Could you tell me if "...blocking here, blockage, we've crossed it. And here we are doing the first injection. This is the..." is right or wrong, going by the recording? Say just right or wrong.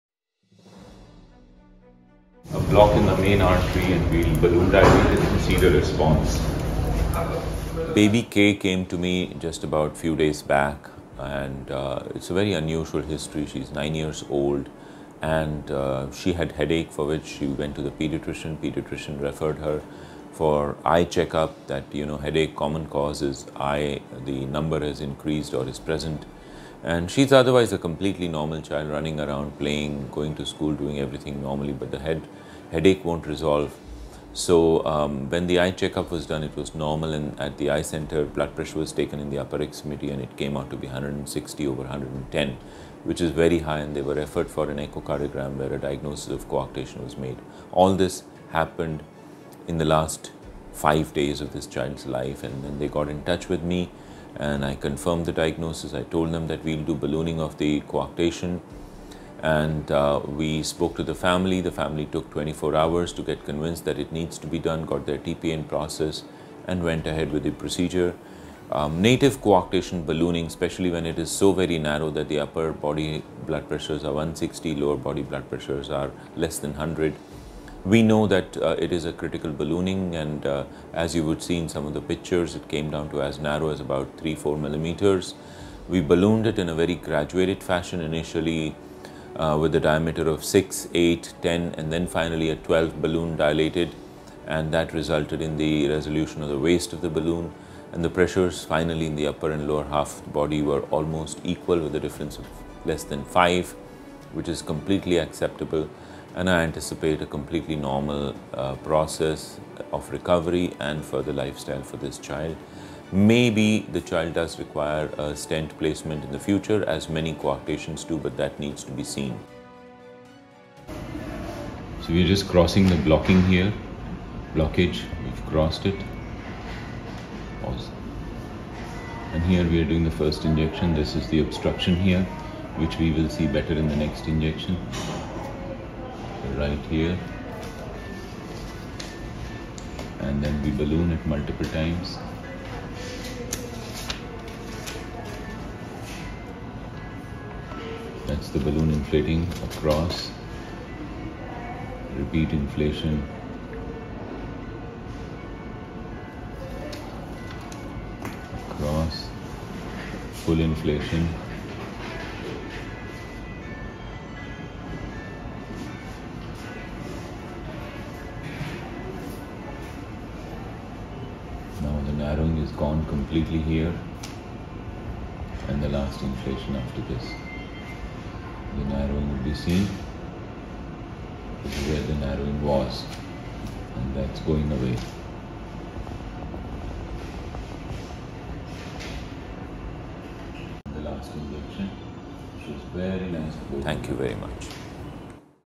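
right.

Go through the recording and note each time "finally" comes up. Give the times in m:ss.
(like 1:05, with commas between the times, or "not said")
1:32, 1:38.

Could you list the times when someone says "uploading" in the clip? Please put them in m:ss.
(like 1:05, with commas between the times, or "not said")
not said.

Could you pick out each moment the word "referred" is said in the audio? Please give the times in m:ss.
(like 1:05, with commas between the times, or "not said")
0:19, 0:44.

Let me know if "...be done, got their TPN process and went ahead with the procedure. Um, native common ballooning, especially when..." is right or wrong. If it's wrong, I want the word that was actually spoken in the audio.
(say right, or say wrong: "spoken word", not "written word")
wrong: "coarctation", not "common".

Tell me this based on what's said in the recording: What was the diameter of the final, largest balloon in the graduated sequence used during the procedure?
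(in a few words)
12.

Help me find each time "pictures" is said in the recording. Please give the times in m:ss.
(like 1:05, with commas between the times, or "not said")
1:22.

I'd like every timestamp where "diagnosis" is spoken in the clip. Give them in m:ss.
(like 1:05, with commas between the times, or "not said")
0:45, 0:55.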